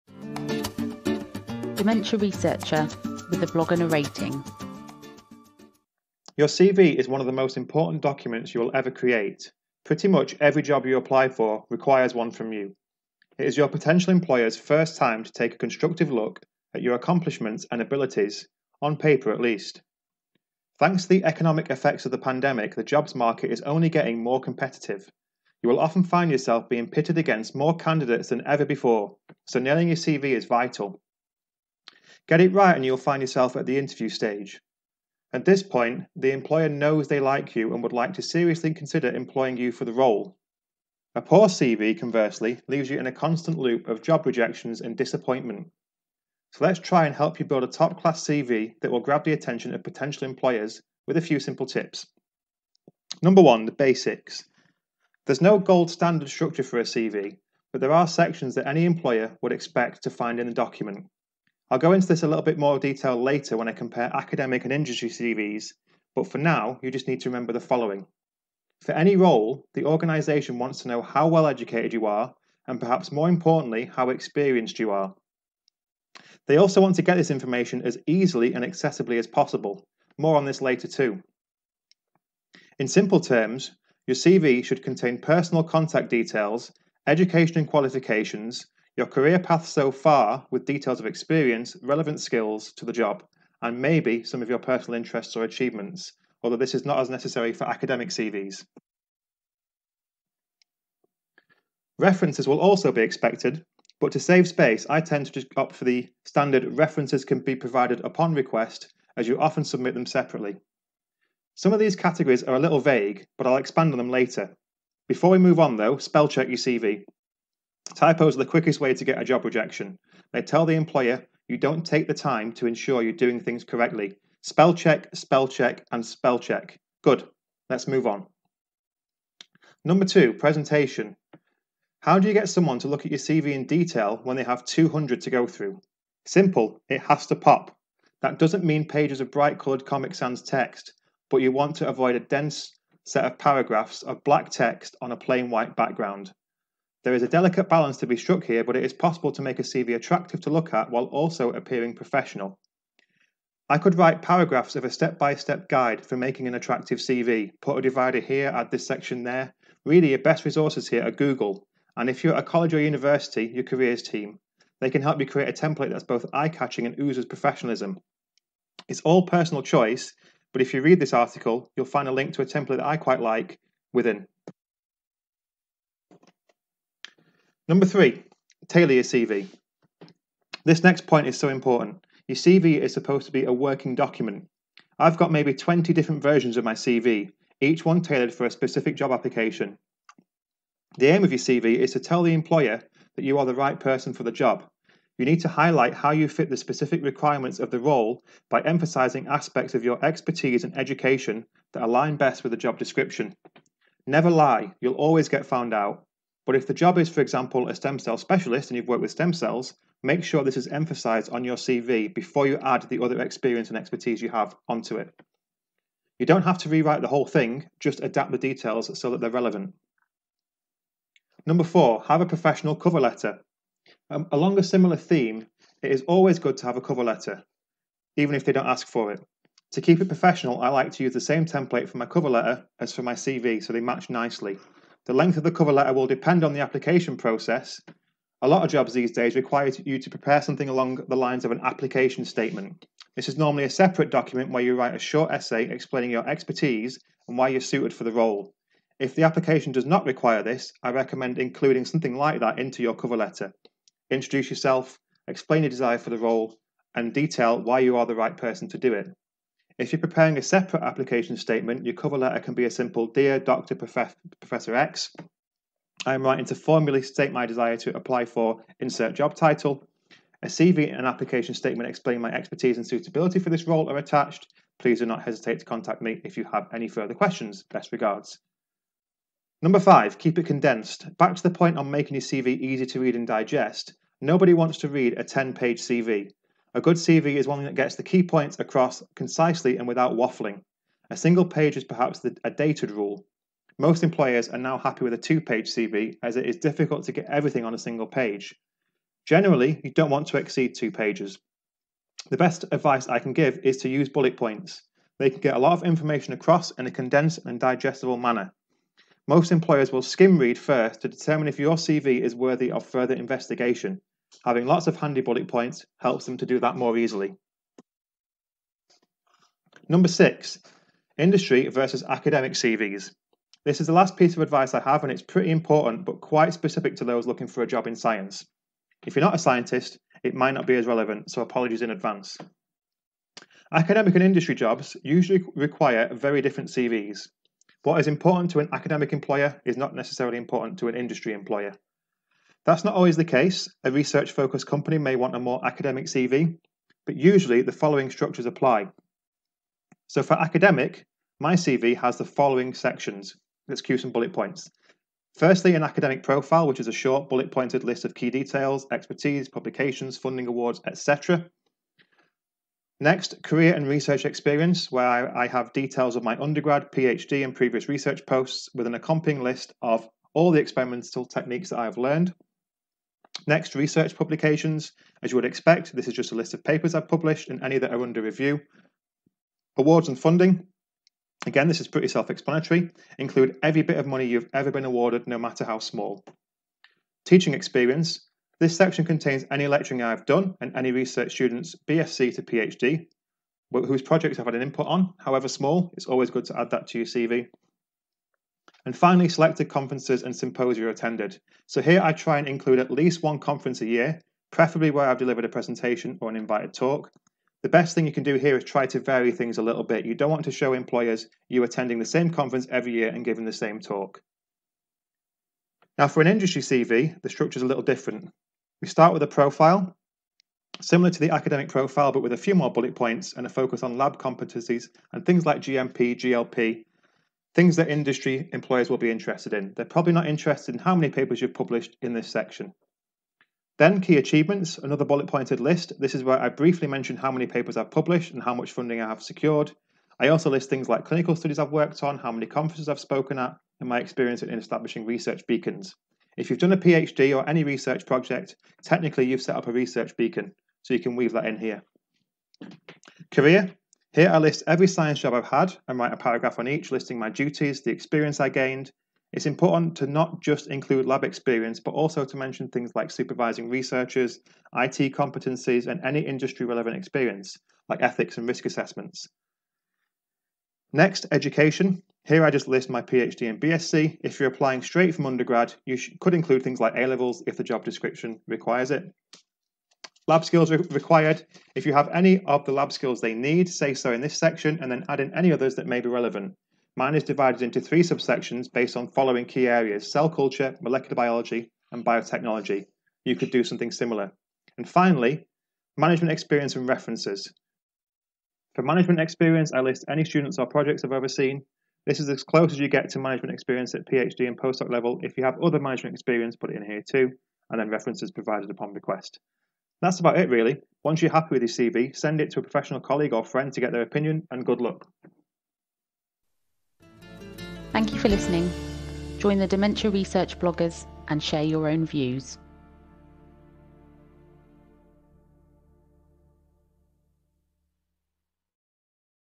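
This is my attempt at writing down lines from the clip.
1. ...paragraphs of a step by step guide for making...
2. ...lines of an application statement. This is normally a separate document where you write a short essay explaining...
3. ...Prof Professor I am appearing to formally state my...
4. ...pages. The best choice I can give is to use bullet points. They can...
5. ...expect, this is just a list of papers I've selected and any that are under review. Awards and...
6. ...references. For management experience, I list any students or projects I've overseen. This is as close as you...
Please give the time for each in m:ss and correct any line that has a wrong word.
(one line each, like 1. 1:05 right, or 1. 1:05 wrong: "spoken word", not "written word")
1. 2:34 right
2. 4:01 right
3. 4:23 wrong: "writing", not "appearing"
4. 5:00 wrong: "advice", not "choice"
5. 6:15 wrong: "published", not "selected"
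6. 8:16 right.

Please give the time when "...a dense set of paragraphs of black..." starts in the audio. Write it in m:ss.
2:22.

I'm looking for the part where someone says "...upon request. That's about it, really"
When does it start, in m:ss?
8:28.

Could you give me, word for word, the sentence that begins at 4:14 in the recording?
Introduce yourself, explain your desire for the role, and detail why you are the right person to do it.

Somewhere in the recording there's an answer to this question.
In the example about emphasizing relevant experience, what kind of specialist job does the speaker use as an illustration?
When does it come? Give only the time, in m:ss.
3:27.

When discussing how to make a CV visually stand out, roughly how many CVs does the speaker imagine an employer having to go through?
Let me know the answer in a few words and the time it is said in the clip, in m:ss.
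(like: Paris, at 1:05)
200, at 2:14.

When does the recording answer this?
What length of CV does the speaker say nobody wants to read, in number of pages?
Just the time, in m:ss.
4:45.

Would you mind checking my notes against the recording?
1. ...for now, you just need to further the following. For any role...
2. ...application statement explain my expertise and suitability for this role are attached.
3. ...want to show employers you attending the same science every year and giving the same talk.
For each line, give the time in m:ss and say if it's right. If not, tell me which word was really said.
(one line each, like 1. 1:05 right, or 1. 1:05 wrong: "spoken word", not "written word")
1. 1:06 wrong: "remember", not "further"
2. 4:31 right
3. 6:50 wrong: "conference", not "science".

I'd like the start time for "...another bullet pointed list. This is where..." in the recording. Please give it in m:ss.
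7:14.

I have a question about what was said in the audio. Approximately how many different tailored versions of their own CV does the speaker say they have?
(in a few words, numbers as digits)
20.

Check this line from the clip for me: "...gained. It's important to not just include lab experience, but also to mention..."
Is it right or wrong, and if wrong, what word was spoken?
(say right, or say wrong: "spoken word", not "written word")
right.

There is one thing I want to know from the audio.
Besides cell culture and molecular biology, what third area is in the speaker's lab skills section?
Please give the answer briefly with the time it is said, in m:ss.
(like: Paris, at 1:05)
biotechnology, at 8:12.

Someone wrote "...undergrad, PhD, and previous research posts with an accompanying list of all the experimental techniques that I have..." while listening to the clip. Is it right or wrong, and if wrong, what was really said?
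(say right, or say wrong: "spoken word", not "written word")
right.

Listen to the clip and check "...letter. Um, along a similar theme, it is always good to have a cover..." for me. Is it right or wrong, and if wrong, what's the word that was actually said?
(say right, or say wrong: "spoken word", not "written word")
right.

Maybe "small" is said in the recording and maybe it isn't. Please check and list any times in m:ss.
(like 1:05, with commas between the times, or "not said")
6:25, 6:35.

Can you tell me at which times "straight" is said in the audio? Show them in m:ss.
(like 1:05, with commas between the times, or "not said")
7:54.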